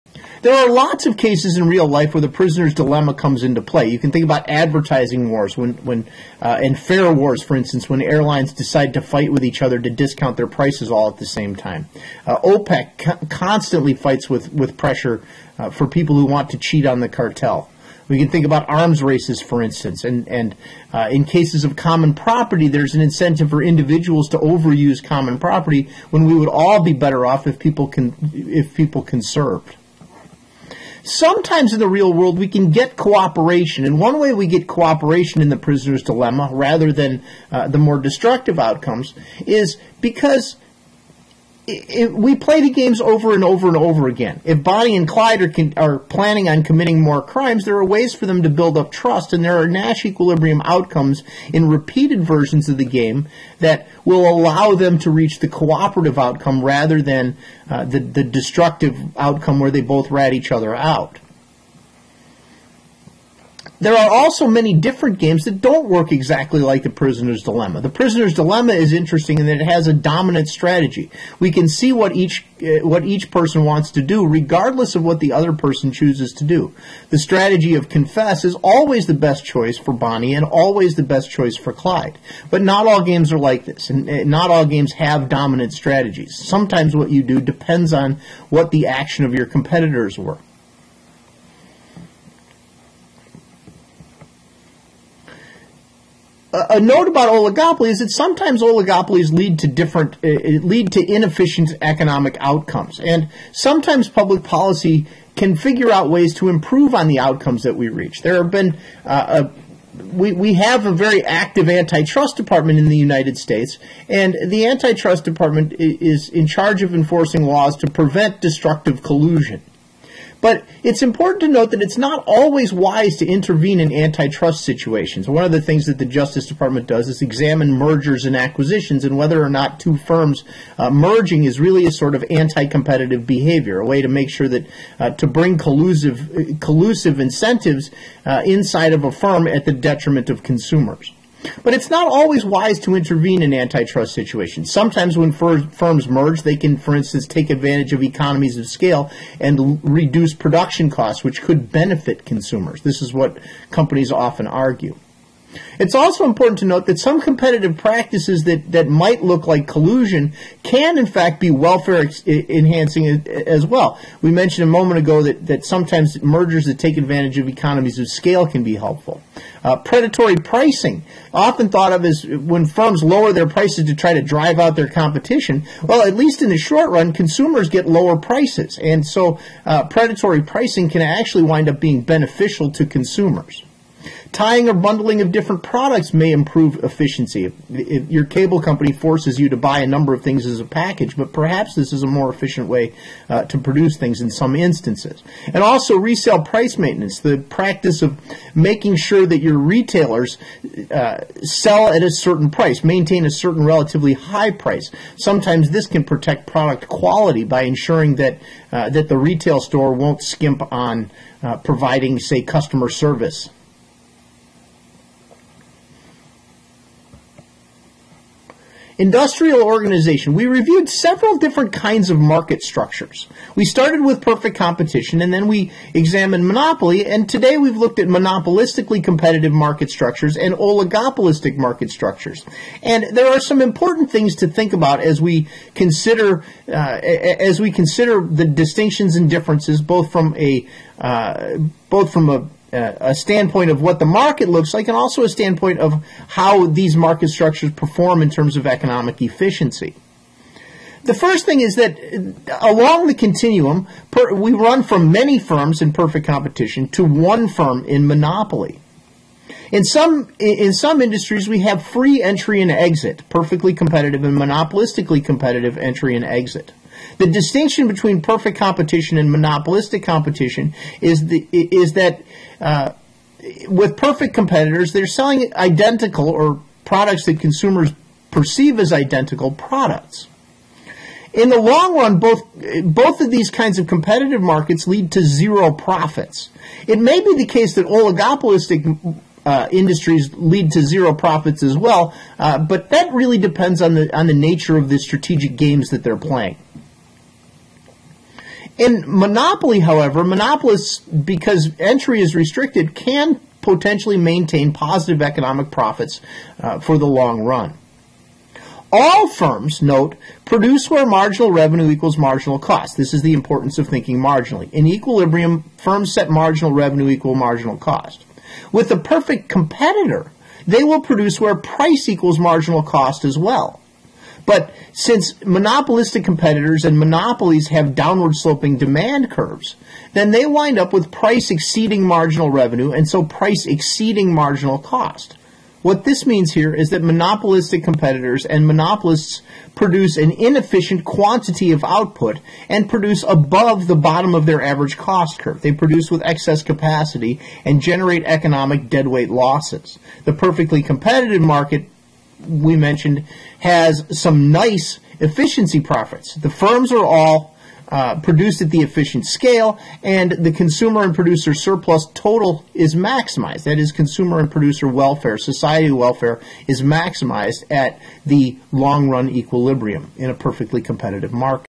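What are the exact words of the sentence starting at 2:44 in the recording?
We mentioned a moment ago that, that sometimes mergers that take advantage of economies of scale can be helpful.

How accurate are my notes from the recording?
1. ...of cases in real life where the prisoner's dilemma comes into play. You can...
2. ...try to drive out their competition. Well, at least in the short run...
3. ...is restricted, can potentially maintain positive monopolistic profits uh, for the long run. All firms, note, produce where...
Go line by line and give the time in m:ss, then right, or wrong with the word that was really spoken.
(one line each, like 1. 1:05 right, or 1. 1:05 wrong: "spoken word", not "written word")
1. 0:01 right
2. 2:53 right
3. 5:02 wrong: "economic", not "monopolistic".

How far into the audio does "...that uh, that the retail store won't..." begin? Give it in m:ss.
3:28.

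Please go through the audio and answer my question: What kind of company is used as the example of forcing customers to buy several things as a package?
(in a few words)
cable company.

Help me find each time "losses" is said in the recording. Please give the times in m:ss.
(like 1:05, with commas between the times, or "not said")
5:49.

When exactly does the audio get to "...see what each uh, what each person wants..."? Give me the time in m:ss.
1:11.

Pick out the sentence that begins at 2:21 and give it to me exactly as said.
But it's not always wise to intervene in antitrust situations.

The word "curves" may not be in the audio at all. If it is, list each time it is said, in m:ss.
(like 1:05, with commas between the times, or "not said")
5:29, 5:45.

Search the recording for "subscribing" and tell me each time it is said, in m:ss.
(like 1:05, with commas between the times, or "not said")
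not said.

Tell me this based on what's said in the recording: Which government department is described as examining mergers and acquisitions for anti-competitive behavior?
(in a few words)
Justice Department.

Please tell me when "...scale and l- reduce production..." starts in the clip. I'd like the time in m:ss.
2:28.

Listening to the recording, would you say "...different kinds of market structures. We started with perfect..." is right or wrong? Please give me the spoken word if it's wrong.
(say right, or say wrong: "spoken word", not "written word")
right.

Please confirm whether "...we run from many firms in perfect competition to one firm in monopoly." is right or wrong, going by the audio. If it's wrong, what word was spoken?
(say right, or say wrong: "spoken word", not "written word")
right.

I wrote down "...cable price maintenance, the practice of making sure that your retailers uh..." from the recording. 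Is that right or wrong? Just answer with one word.
wrong.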